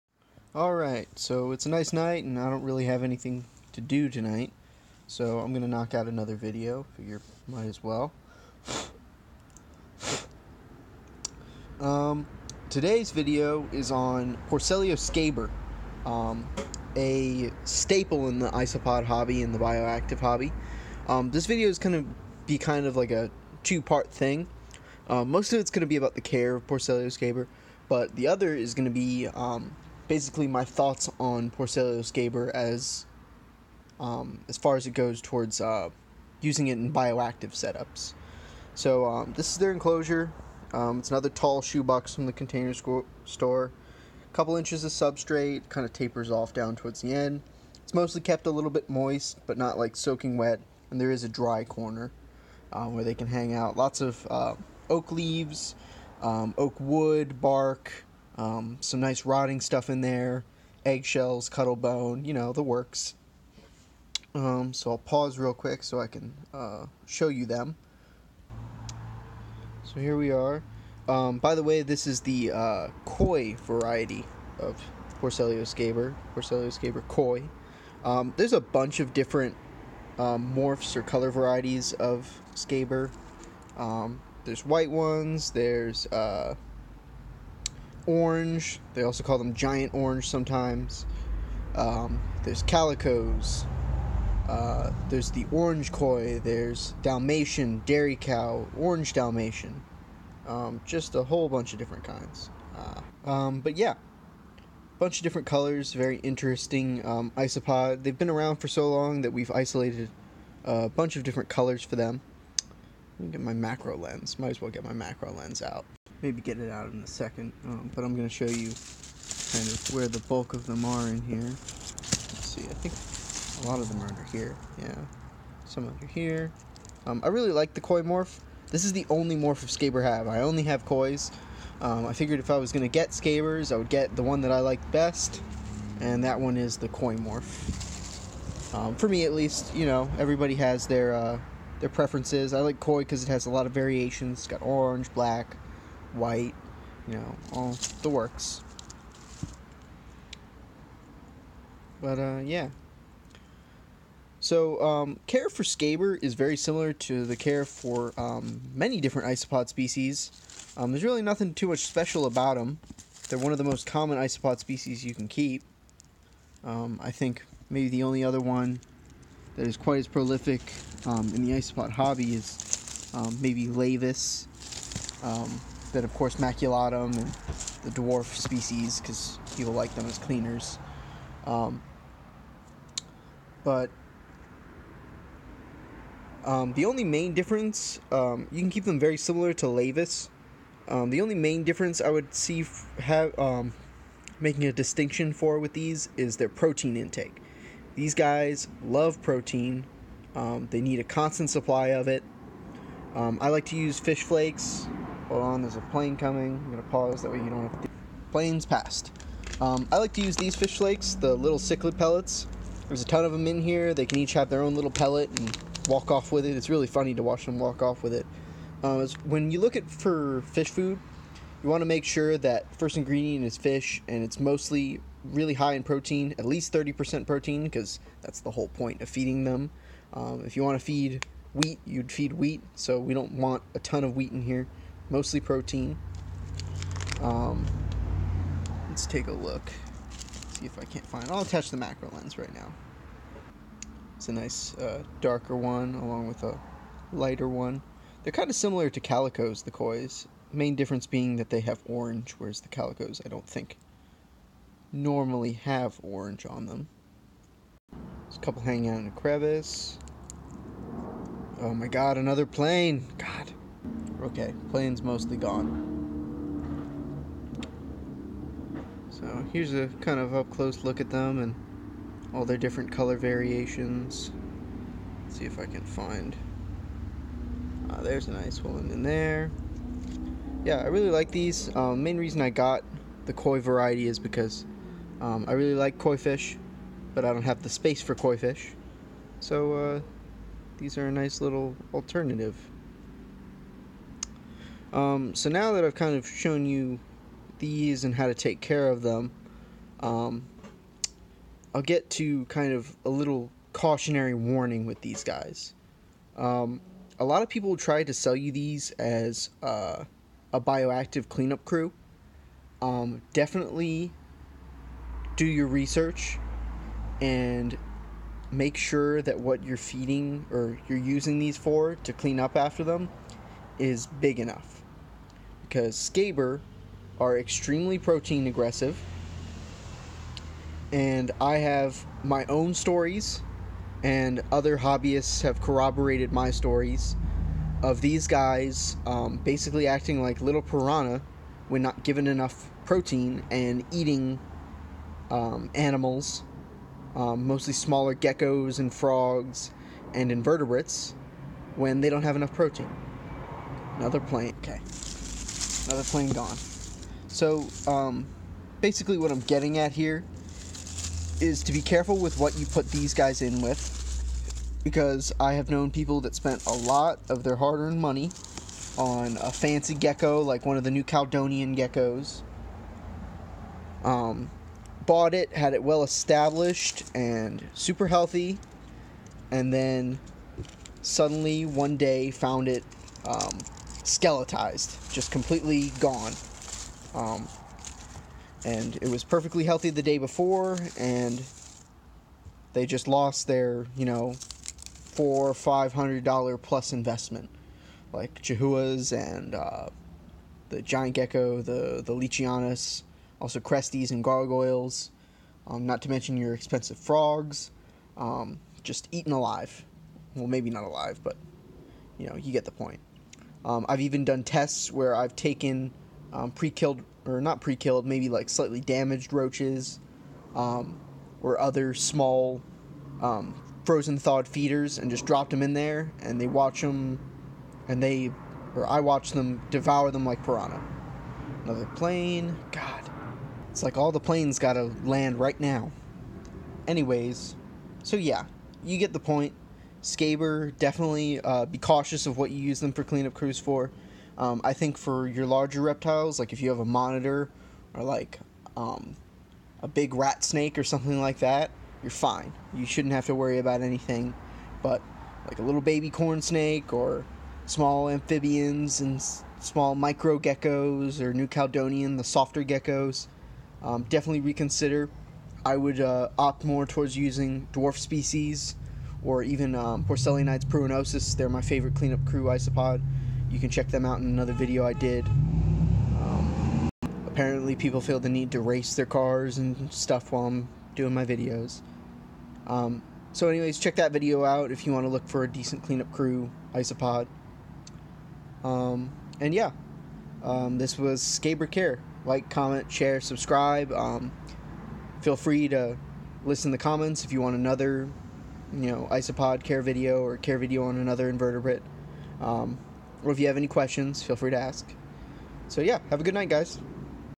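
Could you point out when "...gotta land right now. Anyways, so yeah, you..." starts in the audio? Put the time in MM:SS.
07:14.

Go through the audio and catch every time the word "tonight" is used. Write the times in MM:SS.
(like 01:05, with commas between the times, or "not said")
00:04.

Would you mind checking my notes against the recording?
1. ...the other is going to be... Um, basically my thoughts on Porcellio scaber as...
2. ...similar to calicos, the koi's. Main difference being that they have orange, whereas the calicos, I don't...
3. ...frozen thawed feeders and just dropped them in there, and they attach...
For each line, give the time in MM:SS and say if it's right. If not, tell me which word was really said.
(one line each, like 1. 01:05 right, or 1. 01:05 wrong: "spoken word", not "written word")
1. 00:28 right
2. 04:08 right
3. 07:03 wrong: "watch", not "attach".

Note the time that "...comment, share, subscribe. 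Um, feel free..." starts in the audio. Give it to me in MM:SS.
08:12.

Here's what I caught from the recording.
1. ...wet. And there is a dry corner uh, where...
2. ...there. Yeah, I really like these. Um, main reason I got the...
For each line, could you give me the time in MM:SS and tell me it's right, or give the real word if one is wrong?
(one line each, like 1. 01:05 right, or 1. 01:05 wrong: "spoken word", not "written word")
1. 00:50 right
2. 04:39 right.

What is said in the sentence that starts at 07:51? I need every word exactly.
They're my favorite cleanup crew isopod.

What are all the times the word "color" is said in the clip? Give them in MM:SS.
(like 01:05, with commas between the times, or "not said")
01:21, 01:45, 01:51, 04:32.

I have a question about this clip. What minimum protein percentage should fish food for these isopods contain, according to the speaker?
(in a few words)
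30%.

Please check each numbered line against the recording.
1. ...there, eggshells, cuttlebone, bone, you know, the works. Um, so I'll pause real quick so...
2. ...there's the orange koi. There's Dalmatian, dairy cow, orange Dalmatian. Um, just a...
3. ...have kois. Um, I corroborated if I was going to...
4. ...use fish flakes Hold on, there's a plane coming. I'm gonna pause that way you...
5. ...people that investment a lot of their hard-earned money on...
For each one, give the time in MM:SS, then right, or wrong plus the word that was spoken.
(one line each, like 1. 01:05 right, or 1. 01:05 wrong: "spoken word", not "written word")
1. 01:00 right
2. 01:35 right
3. 02:10 wrong: "figured", not "corroborated"
4. 03:23 right
5. 06:05 wrong: "spent", not "investment".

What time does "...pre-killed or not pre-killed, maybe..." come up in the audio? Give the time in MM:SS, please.
06:56.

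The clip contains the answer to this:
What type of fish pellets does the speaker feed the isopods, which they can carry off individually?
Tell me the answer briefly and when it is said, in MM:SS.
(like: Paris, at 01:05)
Cichlid pellets, at 03:31.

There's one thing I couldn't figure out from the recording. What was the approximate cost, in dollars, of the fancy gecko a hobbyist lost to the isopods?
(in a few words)
$400-500.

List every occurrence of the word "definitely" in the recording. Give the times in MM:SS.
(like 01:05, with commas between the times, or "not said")
05:13, 07:20, 07:44.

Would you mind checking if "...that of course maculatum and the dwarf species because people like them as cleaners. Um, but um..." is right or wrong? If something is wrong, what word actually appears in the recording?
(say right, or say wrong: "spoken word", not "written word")
right.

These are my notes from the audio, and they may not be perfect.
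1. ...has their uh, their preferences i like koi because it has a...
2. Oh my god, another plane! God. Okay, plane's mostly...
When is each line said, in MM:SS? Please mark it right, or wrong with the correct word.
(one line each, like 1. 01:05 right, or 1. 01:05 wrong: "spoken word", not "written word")
1. 02:20 right
2. 04:21 right.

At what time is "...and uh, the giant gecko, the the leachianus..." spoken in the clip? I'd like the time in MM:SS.
06:39.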